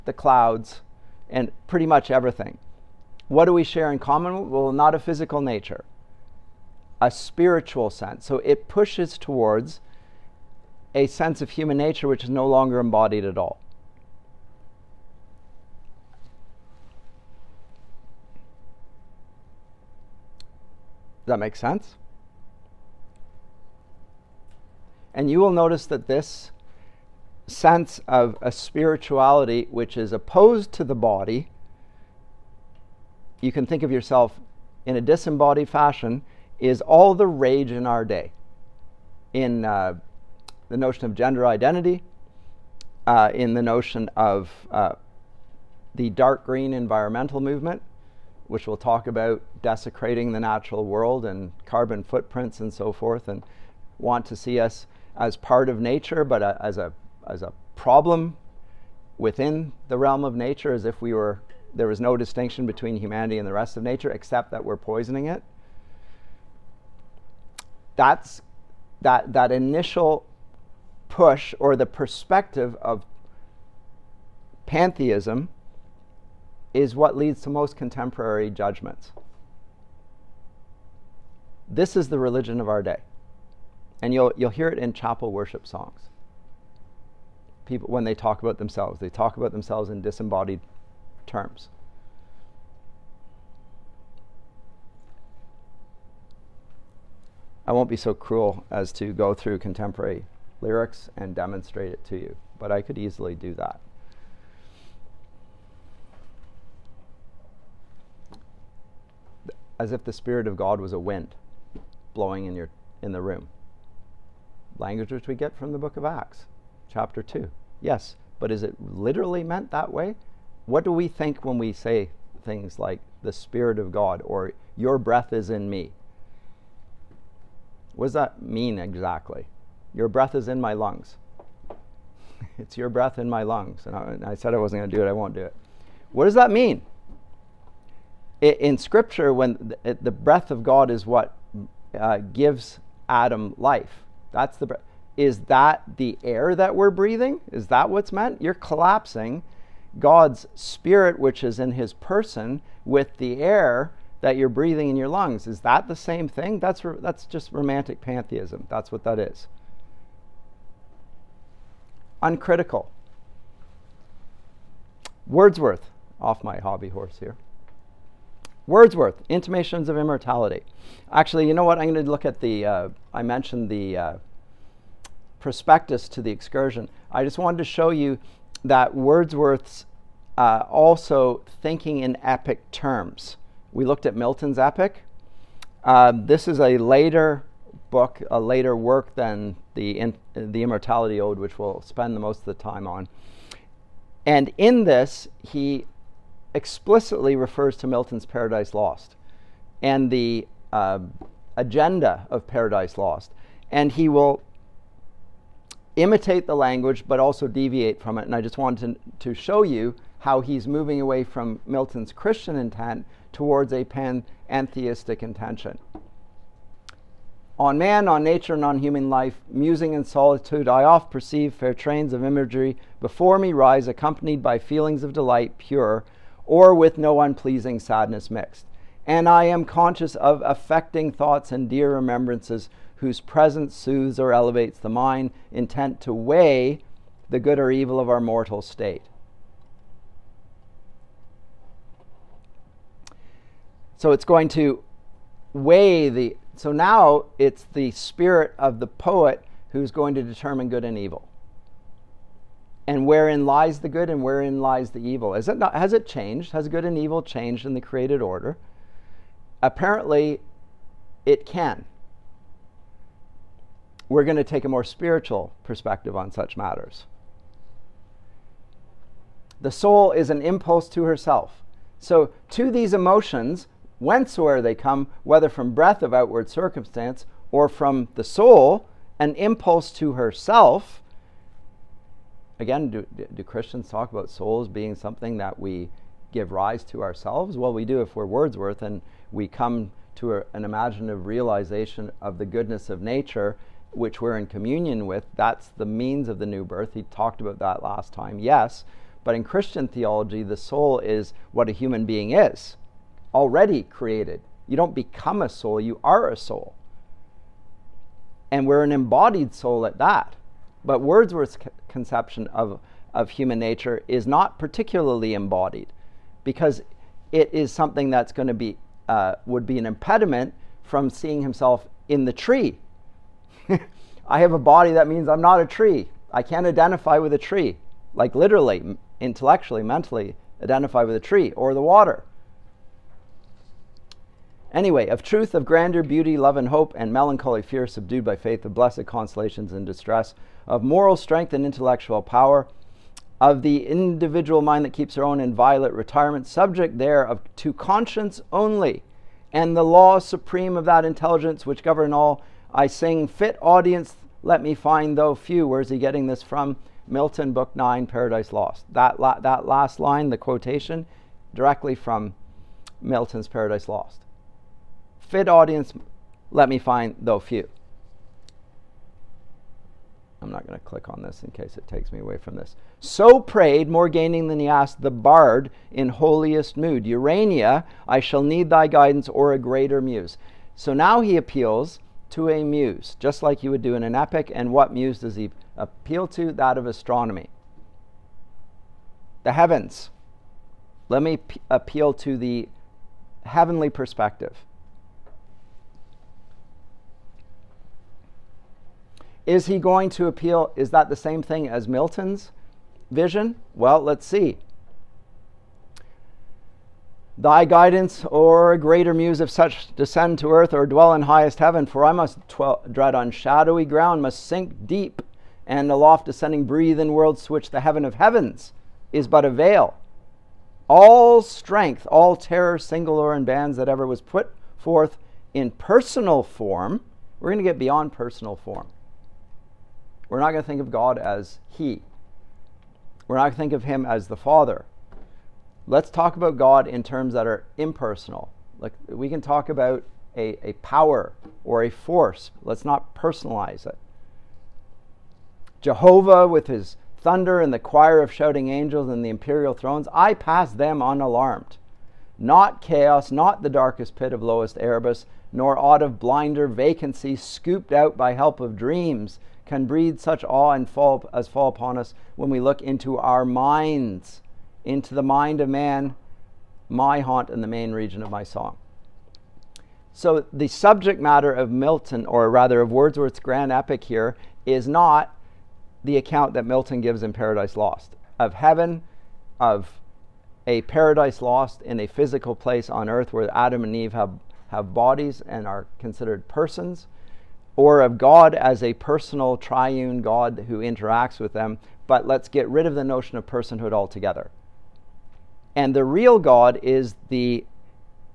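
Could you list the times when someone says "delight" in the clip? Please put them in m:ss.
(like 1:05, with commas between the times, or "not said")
3:45.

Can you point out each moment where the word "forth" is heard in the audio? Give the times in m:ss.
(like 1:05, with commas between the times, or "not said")
0:52, 7:04.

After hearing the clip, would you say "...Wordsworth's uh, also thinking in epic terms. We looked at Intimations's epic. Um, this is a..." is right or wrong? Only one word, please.
wrong.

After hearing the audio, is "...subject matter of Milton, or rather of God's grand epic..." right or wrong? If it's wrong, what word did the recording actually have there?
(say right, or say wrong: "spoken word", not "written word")
wrong: "Wordsworth", not "God".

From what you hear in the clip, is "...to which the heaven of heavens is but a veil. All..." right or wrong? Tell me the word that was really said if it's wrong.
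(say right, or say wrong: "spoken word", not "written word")
right.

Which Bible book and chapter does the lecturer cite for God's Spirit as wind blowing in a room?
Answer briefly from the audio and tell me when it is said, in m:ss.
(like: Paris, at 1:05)
Acts, chapter 2, at 1:55.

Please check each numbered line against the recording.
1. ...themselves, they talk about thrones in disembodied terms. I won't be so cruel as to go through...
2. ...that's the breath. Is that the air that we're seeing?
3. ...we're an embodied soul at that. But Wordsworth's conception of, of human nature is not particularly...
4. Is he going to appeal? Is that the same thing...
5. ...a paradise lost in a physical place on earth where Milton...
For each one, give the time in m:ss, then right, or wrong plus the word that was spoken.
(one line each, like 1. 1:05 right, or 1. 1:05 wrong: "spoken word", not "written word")
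1. 1:28 wrong: "themselves", not "thrones"
2. 2:24 wrong: "breathing", not "seeing"
3. 5:08 right
4. 6:39 right
5. 8:00 wrong: "Adam", not "Milton".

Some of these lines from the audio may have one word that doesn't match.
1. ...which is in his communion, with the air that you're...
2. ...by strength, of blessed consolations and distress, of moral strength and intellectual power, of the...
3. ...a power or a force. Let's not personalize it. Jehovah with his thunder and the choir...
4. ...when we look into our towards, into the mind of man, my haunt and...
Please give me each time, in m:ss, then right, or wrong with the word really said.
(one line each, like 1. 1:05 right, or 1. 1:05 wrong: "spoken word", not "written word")
1. 2:31 wrong: "person", not "communion"
2. 5:38 wrong: "faith", not "strength"
3. 7:20 right
4. 7:42 wrong: "minds", not "towards".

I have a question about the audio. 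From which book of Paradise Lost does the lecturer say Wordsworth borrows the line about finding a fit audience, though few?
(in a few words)
Book 9.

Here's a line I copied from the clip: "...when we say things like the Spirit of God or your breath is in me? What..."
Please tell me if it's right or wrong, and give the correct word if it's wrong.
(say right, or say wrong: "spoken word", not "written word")
right.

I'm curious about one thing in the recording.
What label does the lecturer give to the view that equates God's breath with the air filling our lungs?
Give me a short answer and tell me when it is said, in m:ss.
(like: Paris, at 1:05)
romantic pantheism, at 2:37.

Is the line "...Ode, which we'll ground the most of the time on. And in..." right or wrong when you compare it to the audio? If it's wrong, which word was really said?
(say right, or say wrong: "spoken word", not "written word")
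wrong: "spend", not "ground".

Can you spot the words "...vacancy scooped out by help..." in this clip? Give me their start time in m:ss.
7:36.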